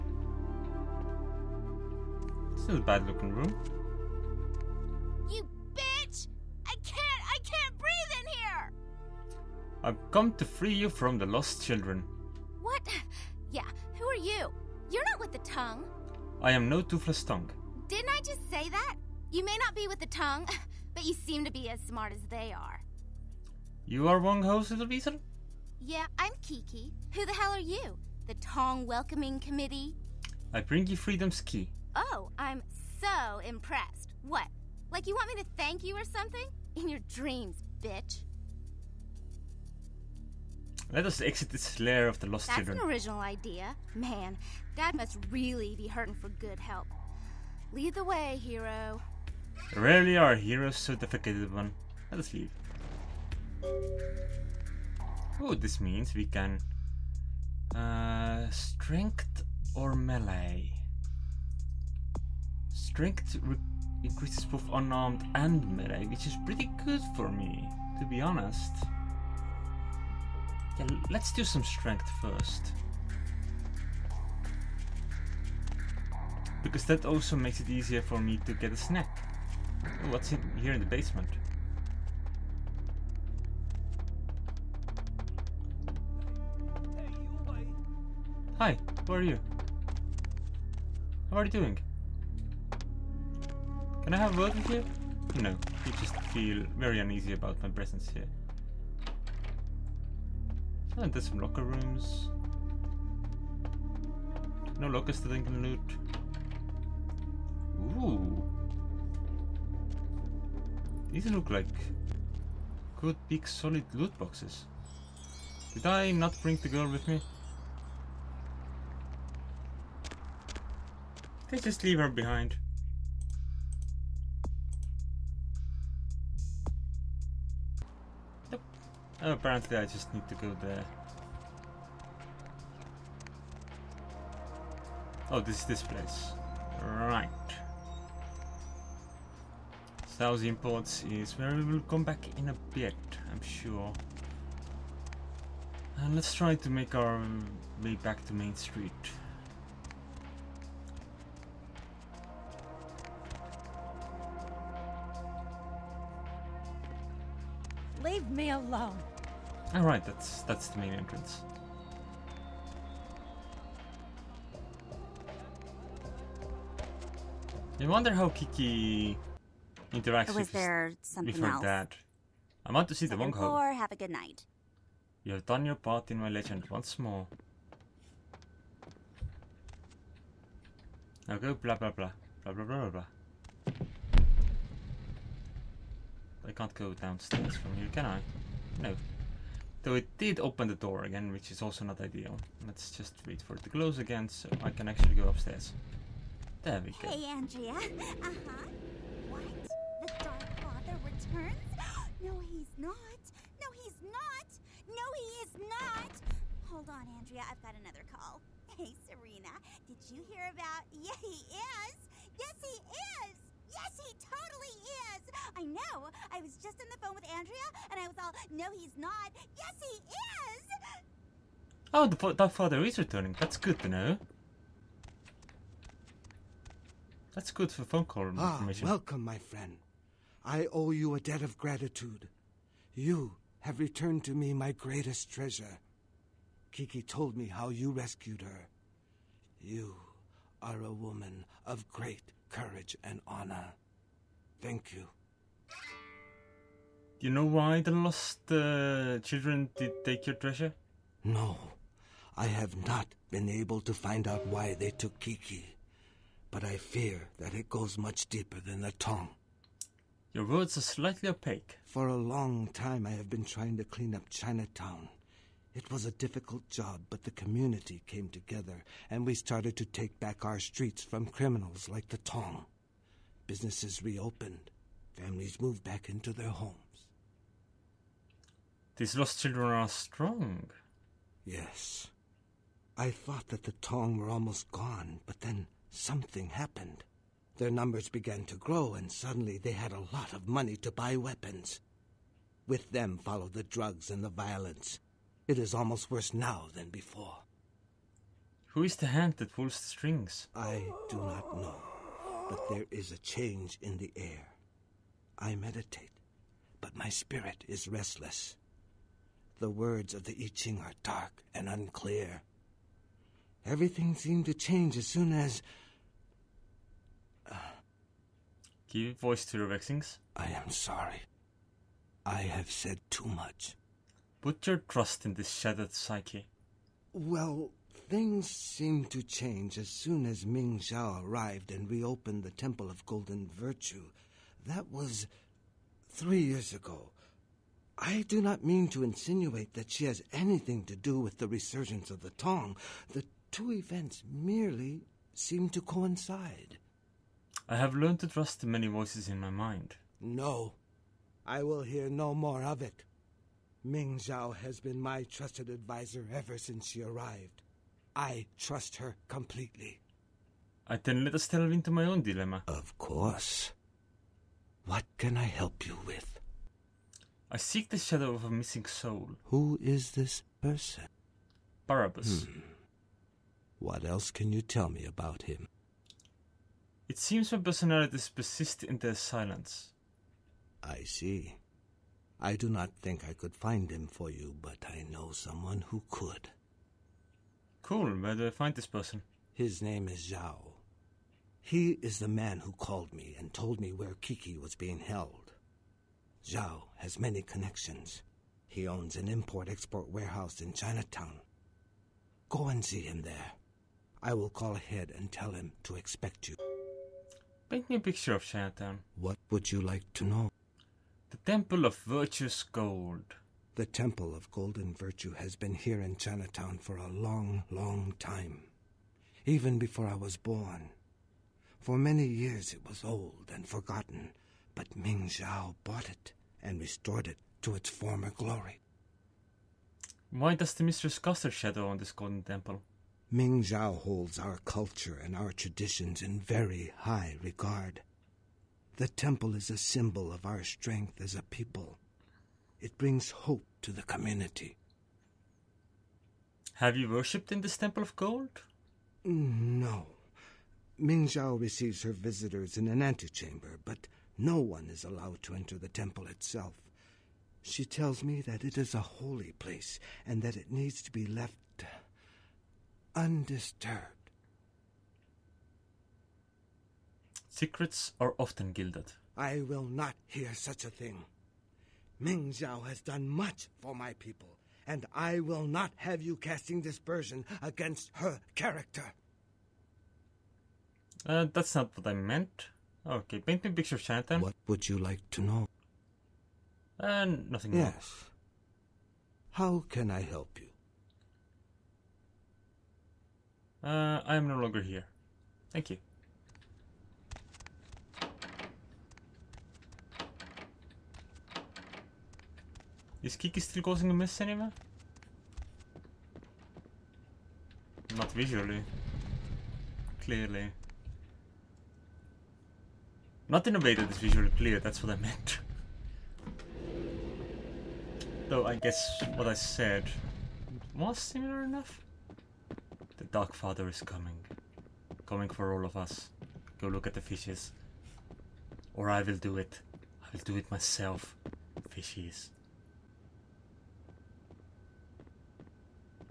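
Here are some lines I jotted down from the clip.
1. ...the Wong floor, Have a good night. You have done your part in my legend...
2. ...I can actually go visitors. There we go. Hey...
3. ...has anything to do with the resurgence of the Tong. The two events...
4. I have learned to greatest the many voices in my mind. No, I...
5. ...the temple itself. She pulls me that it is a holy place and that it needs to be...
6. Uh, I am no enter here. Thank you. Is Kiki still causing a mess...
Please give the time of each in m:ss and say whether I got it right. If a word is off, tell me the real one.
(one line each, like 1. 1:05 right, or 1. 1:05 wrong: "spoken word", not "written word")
1. 2:53 right
2. 3:14 wrong: "upstairs", not "visitors"
3. 5:40 right
4. 5:47 wrong: "trust", not "greatest"
5. 7:35 wrong: "tells", not "pulls"
6. 8:13 wrong: "longer", not "enter".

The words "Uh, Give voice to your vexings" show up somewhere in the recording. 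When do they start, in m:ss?
5:17.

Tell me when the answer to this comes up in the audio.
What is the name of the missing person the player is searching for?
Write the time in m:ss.
6:11.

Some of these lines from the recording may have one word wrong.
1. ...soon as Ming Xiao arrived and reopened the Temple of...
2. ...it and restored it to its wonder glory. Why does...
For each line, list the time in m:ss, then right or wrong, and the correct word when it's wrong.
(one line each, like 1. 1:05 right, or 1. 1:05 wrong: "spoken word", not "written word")
1. 5:29 right
2. 7:06 wrong: "former", not "wonder".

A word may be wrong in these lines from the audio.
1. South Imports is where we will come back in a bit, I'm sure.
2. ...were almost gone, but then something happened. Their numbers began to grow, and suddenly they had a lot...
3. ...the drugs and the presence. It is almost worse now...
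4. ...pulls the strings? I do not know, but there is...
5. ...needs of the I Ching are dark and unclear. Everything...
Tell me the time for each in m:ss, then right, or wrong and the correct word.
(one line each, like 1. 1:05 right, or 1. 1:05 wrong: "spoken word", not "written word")
1. 2:20 right
2. 4:44 right
3. 4:53 wrong: "violence", not "presence"
4. 4:59 right
5. 5:09 wrong: "words", not "needs".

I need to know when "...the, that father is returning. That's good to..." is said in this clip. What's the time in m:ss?
3:42.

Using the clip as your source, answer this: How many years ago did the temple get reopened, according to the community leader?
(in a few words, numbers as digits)
3.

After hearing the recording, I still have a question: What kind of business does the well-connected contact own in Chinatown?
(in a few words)
Import export warehouse.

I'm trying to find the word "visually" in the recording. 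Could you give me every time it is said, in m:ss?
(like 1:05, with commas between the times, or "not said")
8:28, 8:34.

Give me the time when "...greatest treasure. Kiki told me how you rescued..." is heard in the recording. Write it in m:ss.
3:54.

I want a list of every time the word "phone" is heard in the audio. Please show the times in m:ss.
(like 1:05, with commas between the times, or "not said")
3:37, 3:47.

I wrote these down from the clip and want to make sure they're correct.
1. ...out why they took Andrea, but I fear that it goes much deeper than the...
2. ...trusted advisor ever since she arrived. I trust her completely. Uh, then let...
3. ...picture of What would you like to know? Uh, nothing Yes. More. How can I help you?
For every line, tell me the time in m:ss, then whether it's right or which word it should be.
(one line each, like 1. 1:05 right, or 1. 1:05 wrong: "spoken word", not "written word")
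1. 4:14 wrong: "Kiki", not "Andrea"
2. 5:55 right
3. 8:03 right.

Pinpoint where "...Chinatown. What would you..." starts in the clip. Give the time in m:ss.
6:48.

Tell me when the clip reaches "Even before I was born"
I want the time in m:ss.
6:59.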